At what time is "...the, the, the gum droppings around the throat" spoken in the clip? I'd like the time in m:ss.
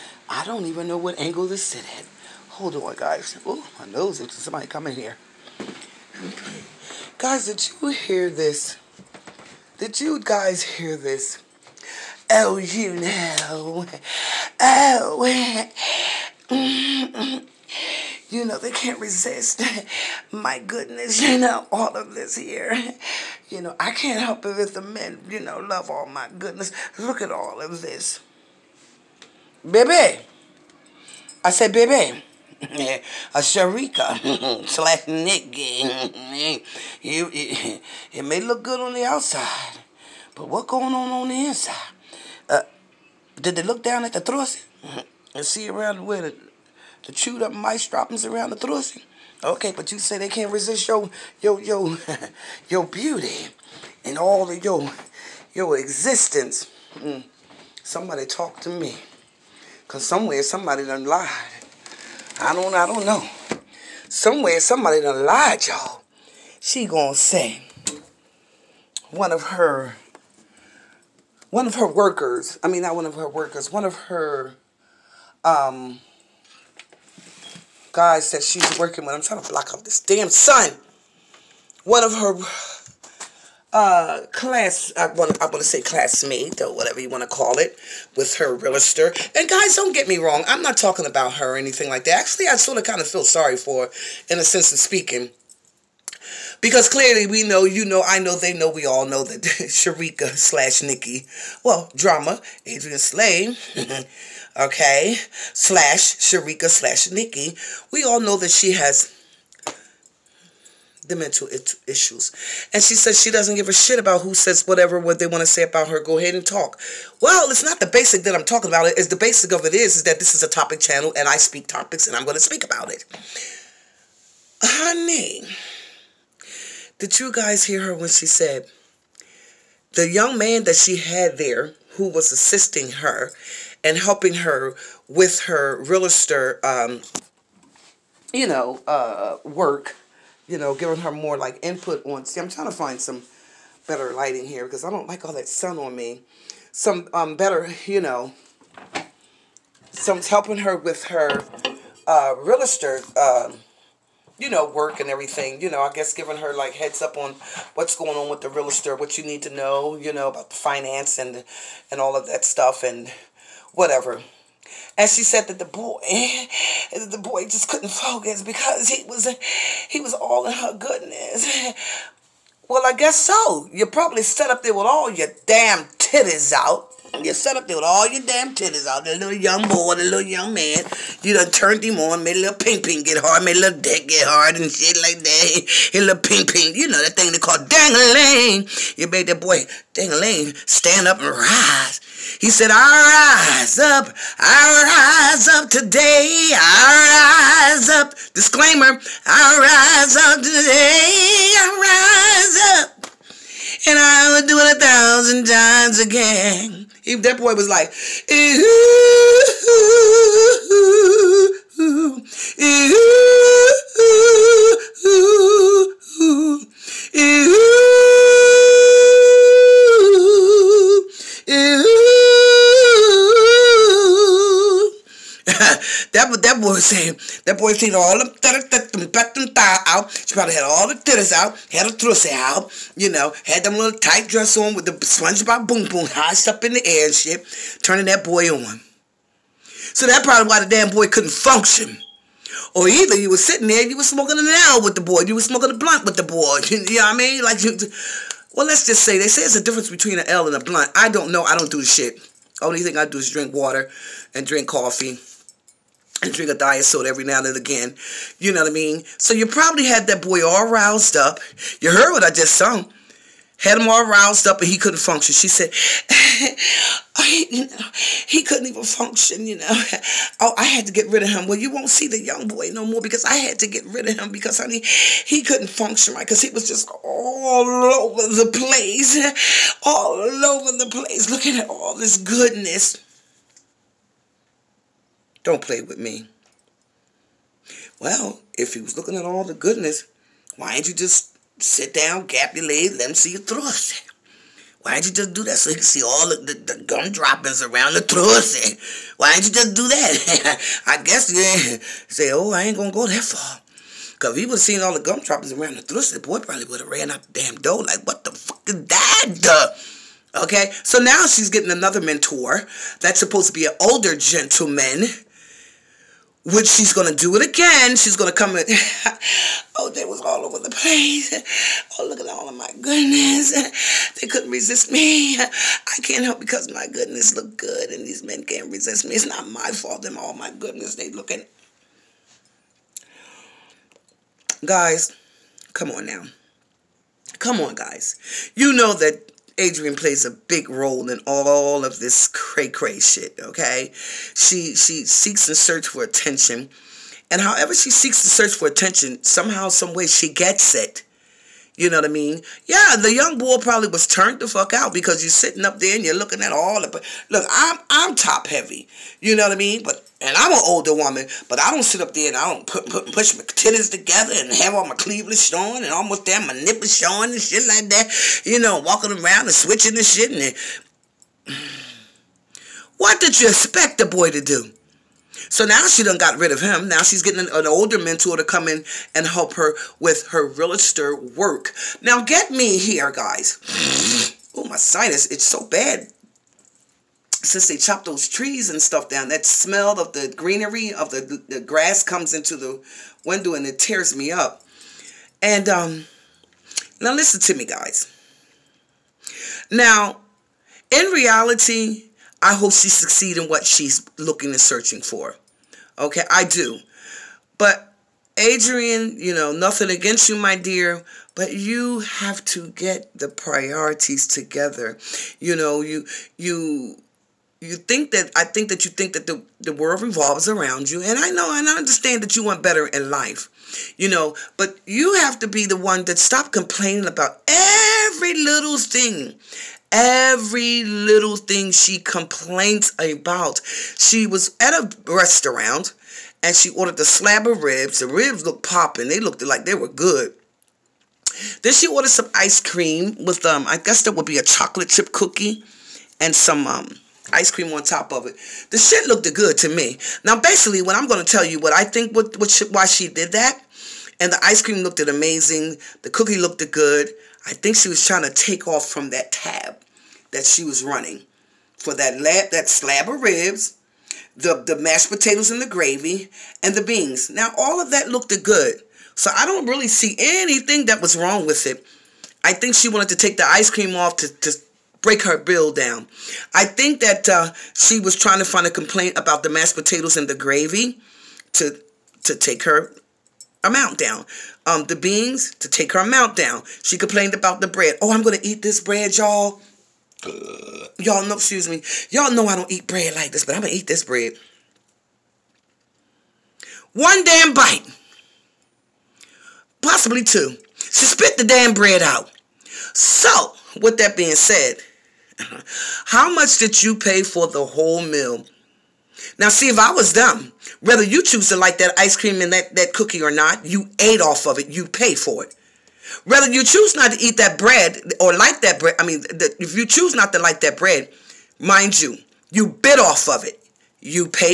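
4:56.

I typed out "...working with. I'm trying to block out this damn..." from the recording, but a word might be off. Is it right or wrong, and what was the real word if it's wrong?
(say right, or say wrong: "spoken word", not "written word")
right.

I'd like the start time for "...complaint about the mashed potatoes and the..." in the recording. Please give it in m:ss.
7:58.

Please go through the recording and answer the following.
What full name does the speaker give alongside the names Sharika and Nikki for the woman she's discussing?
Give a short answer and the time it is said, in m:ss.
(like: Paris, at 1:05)
Adrienne Slay, at 1:42.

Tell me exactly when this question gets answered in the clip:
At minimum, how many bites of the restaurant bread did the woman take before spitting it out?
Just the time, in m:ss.
8:16.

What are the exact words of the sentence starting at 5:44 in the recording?
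She she seeks and searches for attention.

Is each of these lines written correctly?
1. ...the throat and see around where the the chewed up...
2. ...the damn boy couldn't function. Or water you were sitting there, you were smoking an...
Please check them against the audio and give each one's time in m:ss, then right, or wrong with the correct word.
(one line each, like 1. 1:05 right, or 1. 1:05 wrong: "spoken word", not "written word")
1. 0:44 right
2. 4:00 wrong: "either", not "water".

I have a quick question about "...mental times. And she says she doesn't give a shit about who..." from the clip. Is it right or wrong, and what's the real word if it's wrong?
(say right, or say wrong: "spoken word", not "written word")
wrong: "issues", not "times".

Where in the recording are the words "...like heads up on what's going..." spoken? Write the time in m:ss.
2:36.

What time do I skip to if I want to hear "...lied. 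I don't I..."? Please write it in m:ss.
1:01.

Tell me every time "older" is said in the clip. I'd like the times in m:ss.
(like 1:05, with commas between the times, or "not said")
5:13, 6:00, 6:17.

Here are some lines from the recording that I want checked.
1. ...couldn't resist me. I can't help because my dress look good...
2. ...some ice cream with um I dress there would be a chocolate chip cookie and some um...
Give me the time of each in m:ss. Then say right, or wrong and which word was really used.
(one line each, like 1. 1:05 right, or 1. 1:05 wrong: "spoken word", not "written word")
1. 5:24 wrong: "goodness", not "dress"
2. 7:22 wrong: "guess", not "dress".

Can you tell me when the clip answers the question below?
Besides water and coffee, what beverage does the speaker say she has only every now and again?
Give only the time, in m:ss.
4:16.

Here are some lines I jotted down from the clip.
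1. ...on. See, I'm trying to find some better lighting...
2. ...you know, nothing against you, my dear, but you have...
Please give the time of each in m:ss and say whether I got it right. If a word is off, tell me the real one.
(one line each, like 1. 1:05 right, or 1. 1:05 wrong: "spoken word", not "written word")
1. 2:22 right
2. 6:49 right.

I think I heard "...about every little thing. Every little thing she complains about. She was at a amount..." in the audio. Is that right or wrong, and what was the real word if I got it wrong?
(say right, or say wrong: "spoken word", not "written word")
wrong: "restaurant", not "amount".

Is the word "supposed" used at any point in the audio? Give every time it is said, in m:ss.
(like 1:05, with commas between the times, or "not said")
5:13.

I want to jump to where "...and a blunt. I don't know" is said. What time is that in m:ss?
4:10.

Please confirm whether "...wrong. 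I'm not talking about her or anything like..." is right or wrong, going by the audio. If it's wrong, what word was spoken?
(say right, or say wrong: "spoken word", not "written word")
right.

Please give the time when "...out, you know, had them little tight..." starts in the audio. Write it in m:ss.
3:52.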